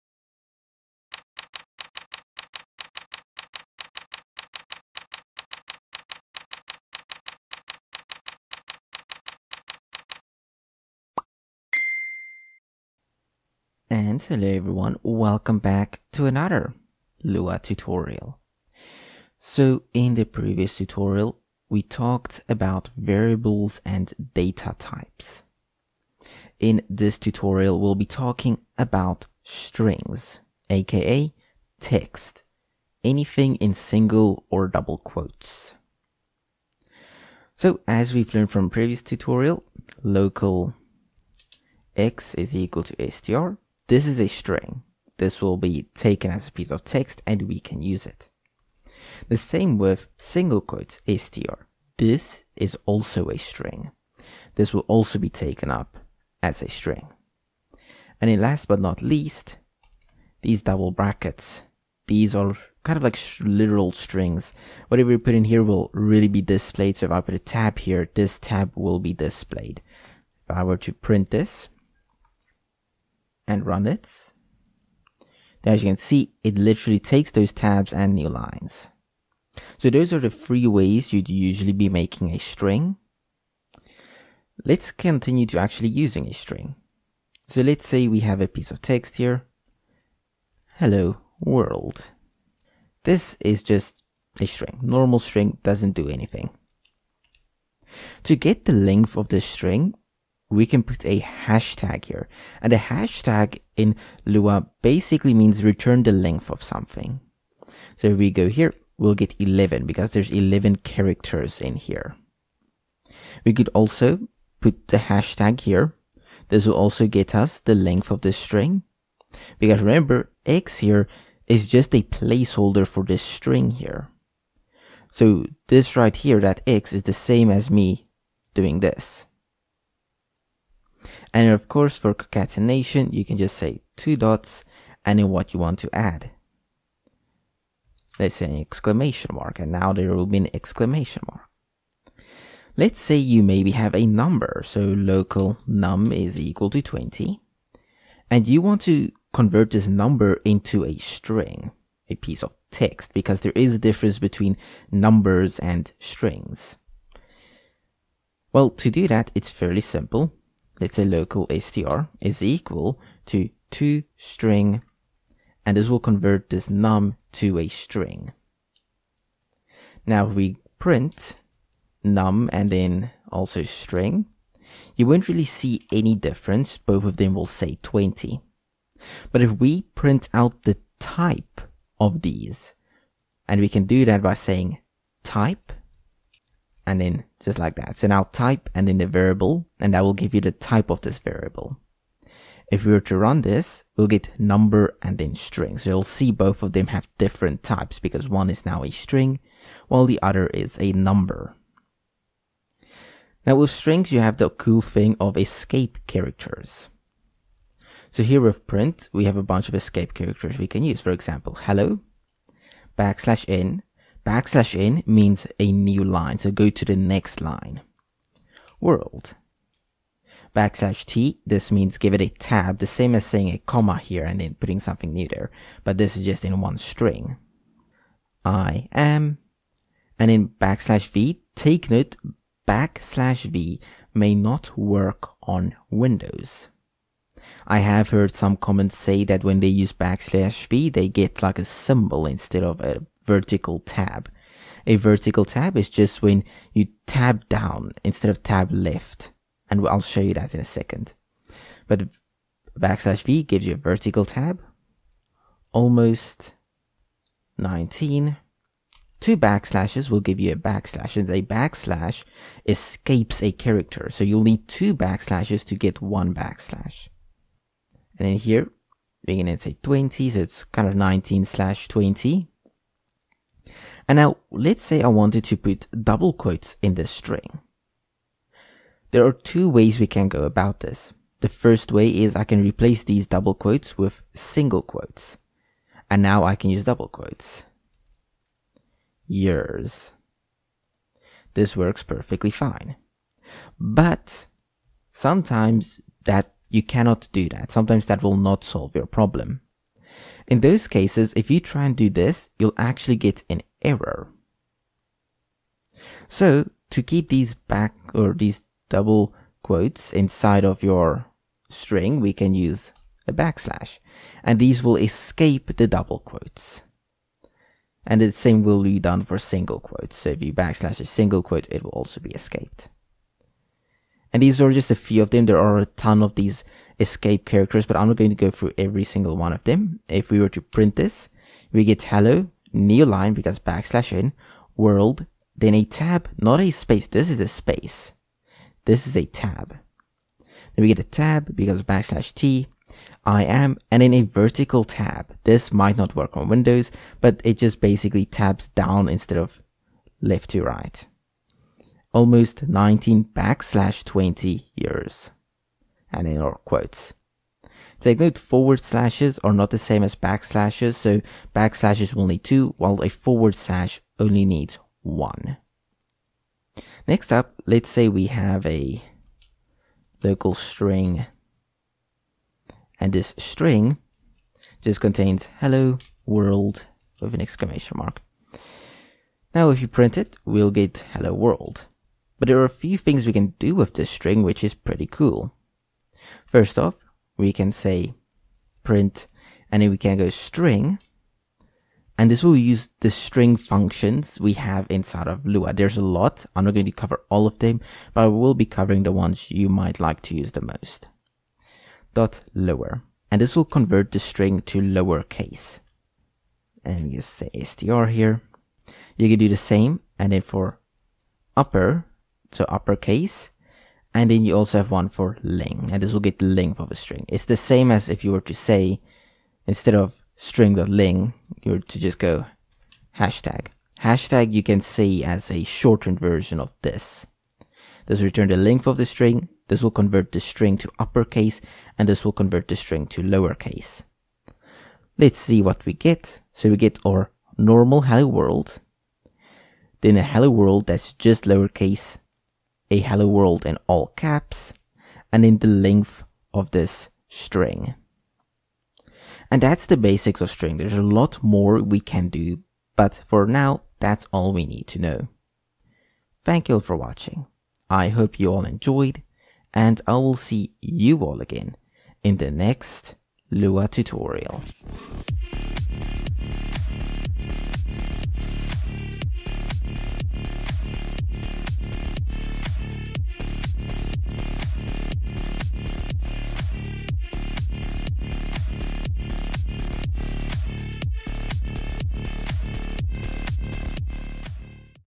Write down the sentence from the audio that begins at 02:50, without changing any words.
Now if we print num and then also string, you won't really see any difference.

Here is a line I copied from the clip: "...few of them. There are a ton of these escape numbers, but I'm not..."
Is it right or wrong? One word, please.
wrong.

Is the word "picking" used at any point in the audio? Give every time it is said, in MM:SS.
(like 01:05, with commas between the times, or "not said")
not said.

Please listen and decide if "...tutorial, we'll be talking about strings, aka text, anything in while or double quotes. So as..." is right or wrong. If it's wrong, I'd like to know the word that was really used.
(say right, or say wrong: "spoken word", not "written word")
wrong: "single", not "while".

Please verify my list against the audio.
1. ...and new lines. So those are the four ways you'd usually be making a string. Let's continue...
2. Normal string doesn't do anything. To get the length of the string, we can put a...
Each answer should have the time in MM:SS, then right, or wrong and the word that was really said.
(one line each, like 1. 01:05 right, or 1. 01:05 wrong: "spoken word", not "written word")
1. 01:17 wrong: "three", not "four"
2. 01:34 right.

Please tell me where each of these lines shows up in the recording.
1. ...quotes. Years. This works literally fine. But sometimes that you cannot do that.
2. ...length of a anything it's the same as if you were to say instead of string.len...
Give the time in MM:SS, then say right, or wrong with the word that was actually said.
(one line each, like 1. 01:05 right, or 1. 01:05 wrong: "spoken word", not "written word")
1. 04:47 wrong: "perfectly", not "literally"
2. 06:56 wrong: "string", not "anything".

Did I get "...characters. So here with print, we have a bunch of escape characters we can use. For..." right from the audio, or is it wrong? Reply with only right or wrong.
right.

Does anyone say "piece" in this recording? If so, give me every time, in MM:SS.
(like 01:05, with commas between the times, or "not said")
00:46, 01:28, 02:32.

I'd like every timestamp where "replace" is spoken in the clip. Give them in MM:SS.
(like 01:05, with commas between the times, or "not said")
04:42.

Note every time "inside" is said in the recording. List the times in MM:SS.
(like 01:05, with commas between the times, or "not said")
05:10, 06:34.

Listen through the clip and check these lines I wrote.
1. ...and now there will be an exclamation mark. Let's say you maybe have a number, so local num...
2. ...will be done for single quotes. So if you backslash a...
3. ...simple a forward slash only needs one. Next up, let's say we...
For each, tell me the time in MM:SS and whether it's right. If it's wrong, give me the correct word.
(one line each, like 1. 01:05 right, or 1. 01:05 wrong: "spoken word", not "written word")
1. 02:19 right
2. 05:18 right
3. 06:02 wrong: "while", not "simple".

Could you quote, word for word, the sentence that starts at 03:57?
I have heard some comments say that when they use backslash v, they get like a symbol instead of a vertical tab.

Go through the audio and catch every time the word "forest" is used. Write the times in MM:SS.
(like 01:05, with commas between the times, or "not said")
not said.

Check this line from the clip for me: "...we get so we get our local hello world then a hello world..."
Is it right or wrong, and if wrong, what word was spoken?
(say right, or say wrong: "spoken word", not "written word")
wrong: "normal", not "local".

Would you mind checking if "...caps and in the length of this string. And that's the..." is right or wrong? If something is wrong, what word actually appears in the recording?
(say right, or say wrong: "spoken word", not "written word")
right.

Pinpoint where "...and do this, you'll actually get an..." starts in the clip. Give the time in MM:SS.
05:01.